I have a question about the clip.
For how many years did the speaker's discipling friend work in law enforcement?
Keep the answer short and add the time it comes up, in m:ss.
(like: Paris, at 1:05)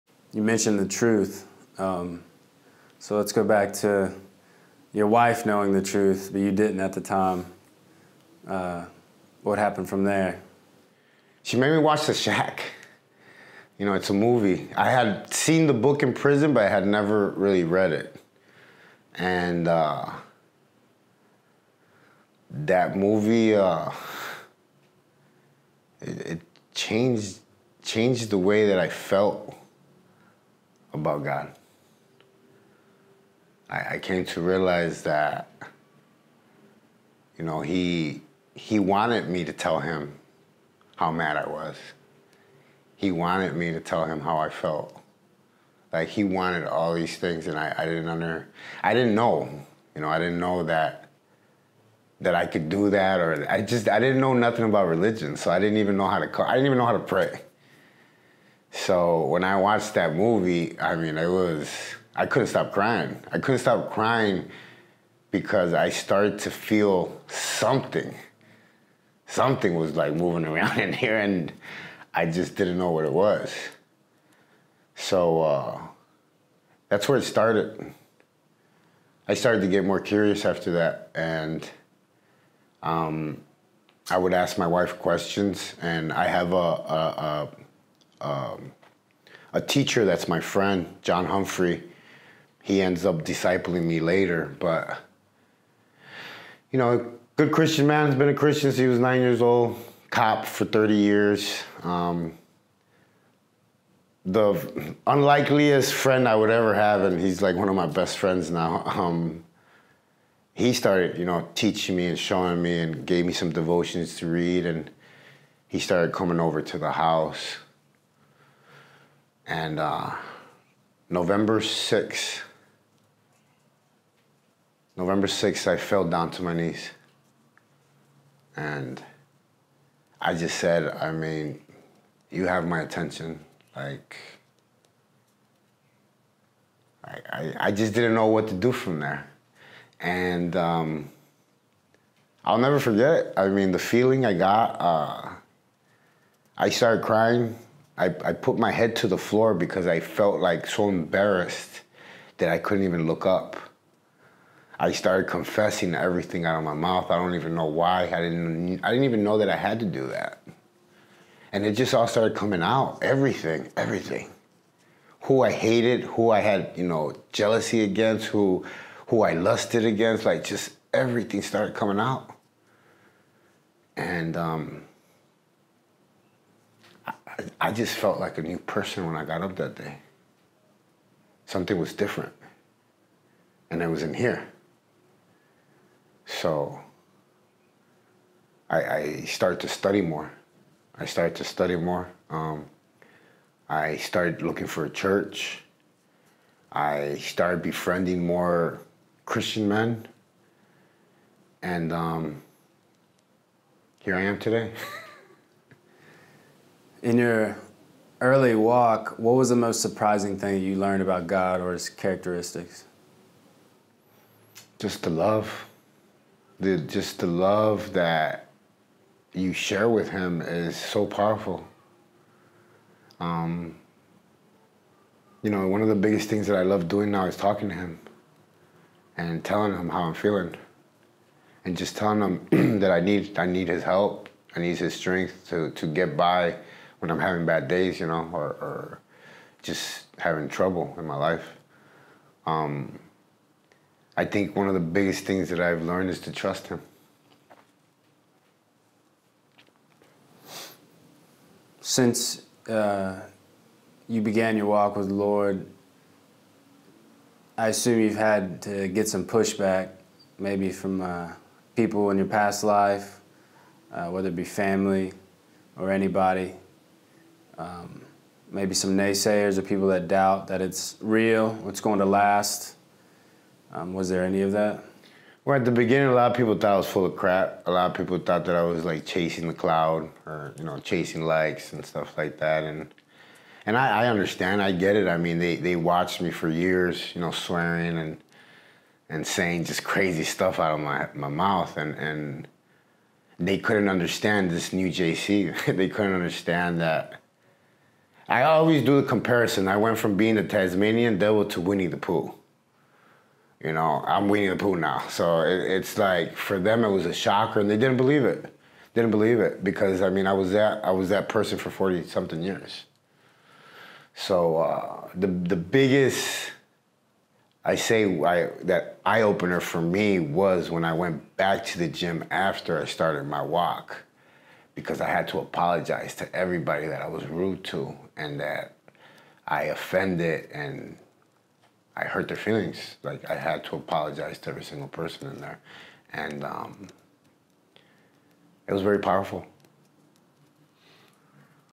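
30, at 1:40.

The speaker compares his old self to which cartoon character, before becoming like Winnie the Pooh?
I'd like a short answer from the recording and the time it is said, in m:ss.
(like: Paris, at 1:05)
Tasmanian devil, at 5:00.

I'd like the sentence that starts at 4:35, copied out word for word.
Well, at the beginning, a lot of people thought I was full of crap.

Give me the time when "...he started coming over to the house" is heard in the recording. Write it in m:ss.
1:55.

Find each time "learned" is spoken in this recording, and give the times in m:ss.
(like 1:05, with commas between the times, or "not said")
3:30, 4:05.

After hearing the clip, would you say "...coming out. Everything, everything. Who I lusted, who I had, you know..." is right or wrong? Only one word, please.
wrong.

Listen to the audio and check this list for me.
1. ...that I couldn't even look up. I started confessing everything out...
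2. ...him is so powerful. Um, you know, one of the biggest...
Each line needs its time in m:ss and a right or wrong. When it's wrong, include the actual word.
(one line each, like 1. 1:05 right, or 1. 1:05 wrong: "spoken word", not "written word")
1. 2:32 right
2. 3:40 right.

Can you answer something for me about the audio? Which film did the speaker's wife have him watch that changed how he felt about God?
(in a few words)
The Shack.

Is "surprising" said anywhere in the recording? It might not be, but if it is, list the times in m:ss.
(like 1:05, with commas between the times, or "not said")
3:29.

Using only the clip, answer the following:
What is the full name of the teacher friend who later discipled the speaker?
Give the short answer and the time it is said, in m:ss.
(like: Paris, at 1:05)
John Humphrey, at 1:31.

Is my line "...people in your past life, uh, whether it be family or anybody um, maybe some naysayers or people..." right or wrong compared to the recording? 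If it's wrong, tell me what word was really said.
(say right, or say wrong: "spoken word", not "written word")
right.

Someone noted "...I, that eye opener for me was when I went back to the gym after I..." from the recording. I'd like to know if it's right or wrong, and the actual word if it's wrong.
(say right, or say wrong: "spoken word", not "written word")
right.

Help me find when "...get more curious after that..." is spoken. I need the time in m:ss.
1:19.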